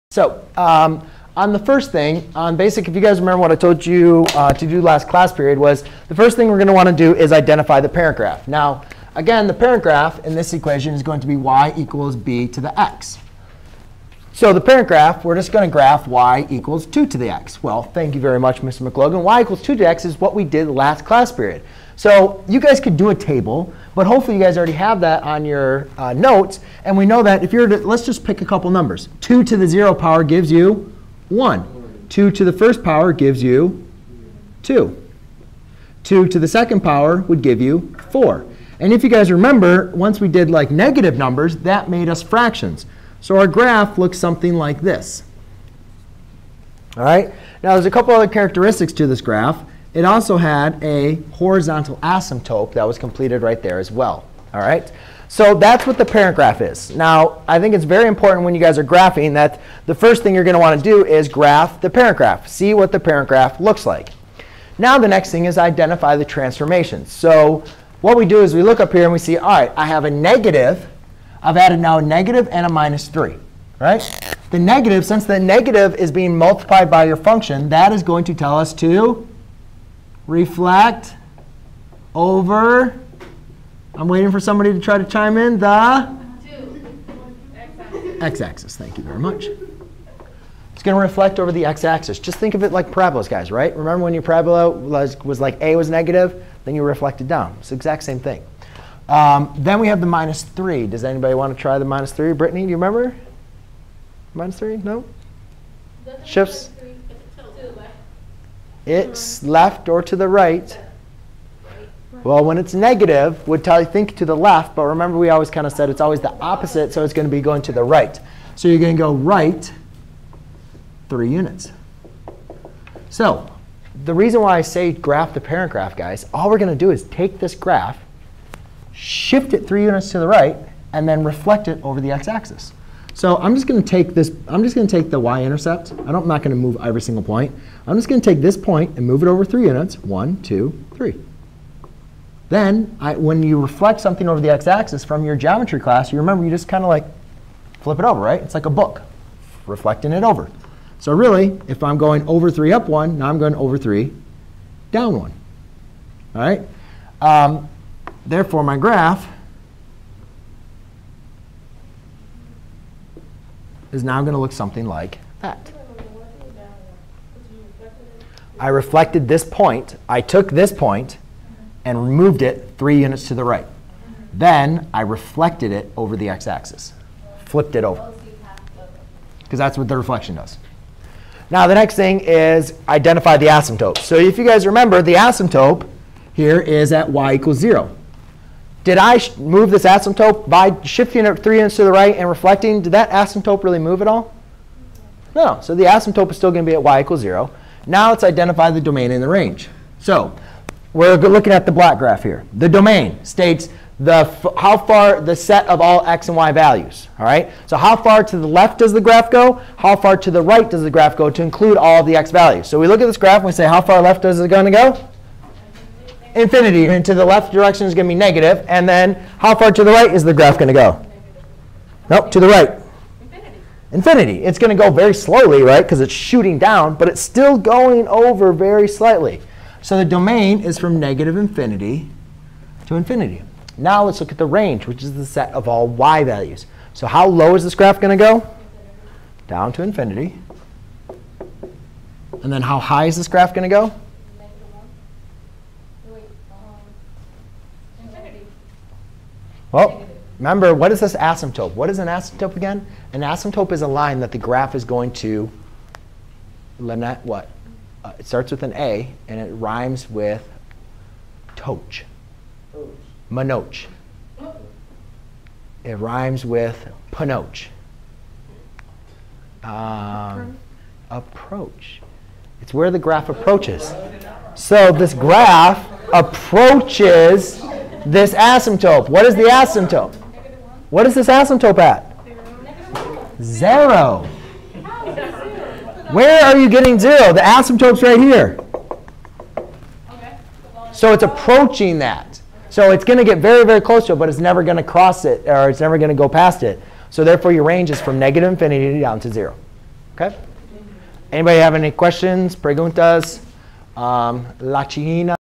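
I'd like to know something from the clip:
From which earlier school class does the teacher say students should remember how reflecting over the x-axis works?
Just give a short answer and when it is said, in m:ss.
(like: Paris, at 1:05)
geometry, at 2:25.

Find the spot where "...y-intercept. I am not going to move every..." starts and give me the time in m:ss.
2:15.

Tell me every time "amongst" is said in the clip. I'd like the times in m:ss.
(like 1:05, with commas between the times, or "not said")
not said.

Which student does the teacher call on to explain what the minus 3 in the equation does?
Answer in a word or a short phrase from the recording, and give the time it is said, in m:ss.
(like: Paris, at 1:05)
Brittany, at 1:42.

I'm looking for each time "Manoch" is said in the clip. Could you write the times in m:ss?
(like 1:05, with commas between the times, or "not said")
4:23.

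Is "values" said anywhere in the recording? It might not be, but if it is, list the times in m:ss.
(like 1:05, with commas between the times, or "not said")
3:26, 3:32, 3:56.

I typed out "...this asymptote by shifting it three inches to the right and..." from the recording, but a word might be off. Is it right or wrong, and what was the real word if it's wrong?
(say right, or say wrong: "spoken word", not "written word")
right.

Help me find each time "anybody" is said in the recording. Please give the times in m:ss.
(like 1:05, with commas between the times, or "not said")
1:41, 5:01.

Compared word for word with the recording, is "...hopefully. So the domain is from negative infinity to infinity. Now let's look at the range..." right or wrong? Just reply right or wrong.
wrong.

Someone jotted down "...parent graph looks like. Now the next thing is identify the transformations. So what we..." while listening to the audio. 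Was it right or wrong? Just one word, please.
right.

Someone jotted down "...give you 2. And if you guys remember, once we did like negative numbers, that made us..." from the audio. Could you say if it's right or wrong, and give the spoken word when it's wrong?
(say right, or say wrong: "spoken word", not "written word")
wrong: "4", not "2".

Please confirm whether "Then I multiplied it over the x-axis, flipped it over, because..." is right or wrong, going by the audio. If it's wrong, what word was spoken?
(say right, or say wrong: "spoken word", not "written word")
wrong: "reflected", not "multiplied".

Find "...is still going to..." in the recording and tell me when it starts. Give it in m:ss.
3:16.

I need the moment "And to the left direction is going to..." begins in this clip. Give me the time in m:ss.
3:36.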